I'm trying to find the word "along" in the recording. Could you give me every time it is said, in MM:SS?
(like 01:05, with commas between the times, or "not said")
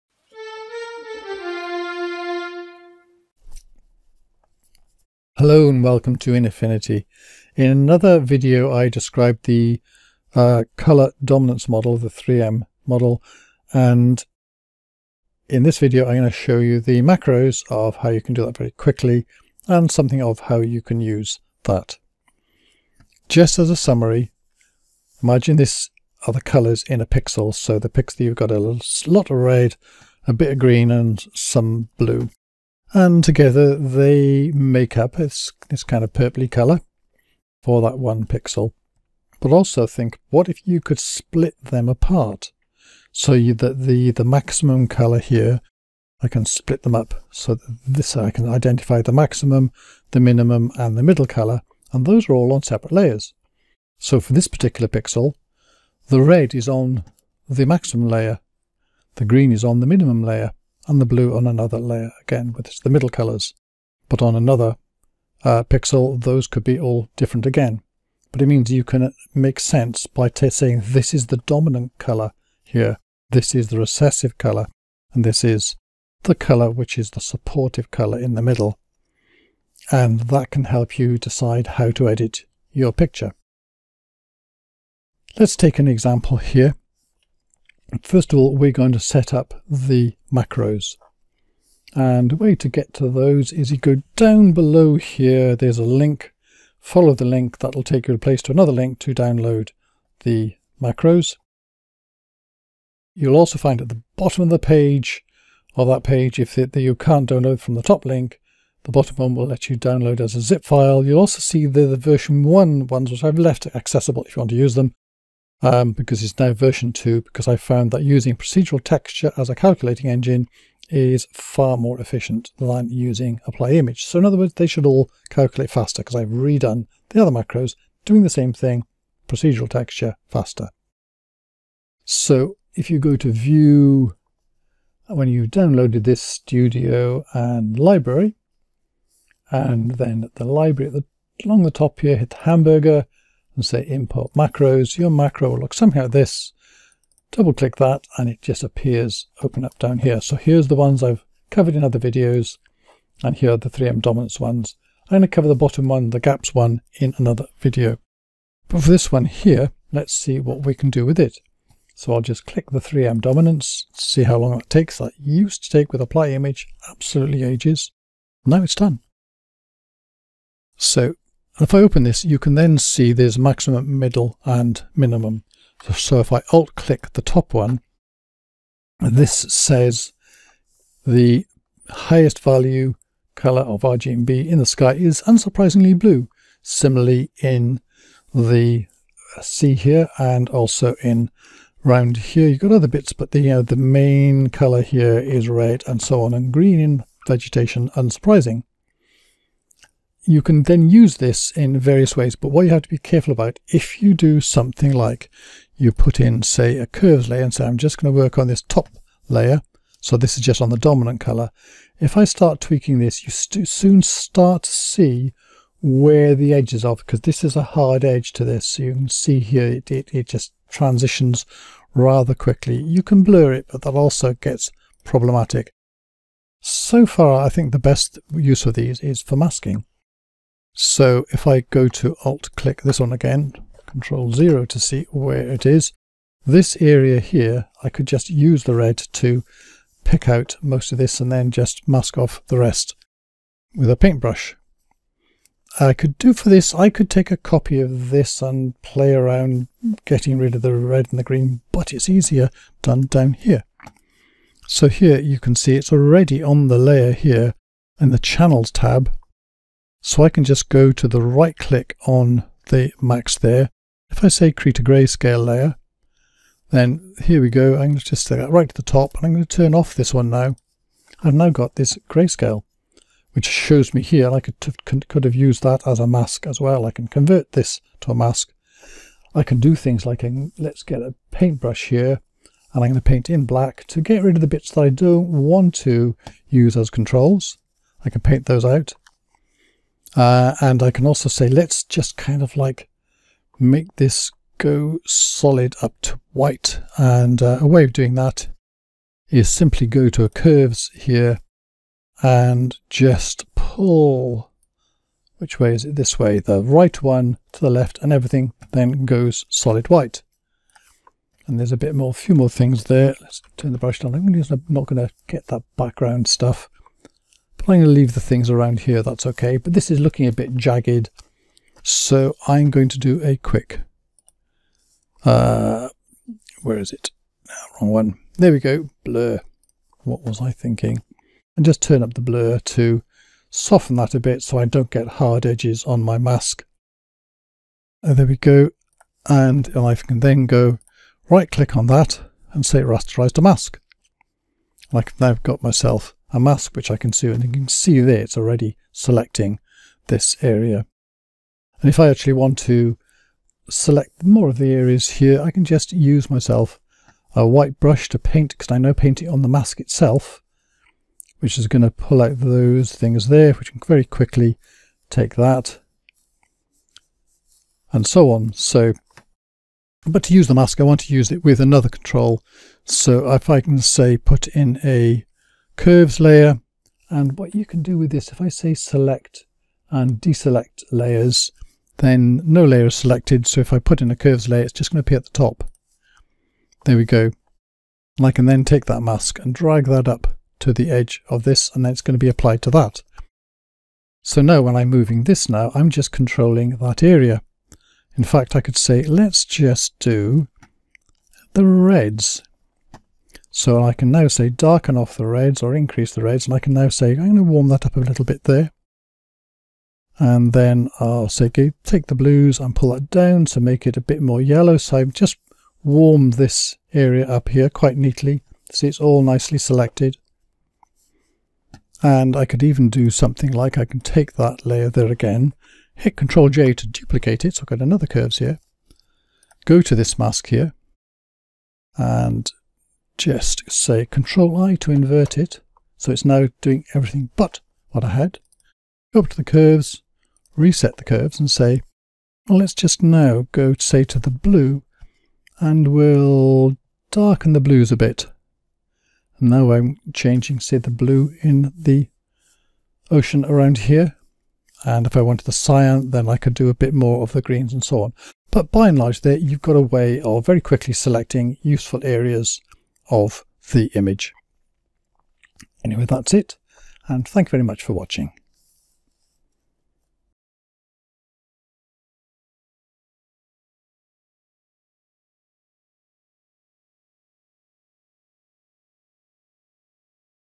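02:21.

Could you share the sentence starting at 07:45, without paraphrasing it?
Anyway, that's it, and thank you very much for watching.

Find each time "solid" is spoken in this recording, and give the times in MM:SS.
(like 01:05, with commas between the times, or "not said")
04:55, 05:09.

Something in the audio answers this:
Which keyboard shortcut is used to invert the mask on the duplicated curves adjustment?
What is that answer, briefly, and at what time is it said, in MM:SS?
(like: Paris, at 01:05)
Control I, at 07:14.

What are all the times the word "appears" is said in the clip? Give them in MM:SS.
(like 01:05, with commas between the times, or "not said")
02:28, 06:25.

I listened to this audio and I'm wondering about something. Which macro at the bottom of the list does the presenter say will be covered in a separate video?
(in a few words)
the gaps one.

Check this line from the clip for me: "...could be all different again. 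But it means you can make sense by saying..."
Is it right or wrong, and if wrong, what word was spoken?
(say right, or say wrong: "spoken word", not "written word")
right.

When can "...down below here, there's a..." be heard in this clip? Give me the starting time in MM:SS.
01:34.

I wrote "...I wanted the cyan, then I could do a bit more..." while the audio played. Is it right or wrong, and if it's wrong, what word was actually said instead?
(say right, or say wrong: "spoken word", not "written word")
right.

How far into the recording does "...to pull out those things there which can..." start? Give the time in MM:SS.
06:01.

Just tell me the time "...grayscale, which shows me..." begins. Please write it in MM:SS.
04:32.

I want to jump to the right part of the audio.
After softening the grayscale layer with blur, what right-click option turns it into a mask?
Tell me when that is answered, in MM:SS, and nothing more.
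05:42.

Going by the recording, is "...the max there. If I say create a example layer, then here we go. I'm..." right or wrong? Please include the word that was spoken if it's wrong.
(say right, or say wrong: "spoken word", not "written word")
wrong: "grayscale", not "example".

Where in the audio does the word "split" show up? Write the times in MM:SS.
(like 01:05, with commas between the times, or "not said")
00:40, 00:46.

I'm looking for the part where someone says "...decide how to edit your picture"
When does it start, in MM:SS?
01:21.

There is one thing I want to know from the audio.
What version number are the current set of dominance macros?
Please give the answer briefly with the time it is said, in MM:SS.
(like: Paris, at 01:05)
2, at 01:56.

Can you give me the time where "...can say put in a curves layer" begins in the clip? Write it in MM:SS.
06:13.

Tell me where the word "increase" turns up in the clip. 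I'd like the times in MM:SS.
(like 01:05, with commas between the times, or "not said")
06:45.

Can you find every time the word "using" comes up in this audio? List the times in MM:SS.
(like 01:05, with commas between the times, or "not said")
01:58, 02:02.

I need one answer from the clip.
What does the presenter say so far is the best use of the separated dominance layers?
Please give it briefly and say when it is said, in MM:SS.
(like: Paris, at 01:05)
masking, at 03:49.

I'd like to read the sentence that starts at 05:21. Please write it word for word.
So I'm going to do a quick, uh, where is it?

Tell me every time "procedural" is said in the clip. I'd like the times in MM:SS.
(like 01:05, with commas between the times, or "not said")
01:58, 02:09.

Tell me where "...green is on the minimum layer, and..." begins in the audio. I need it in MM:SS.
00:59.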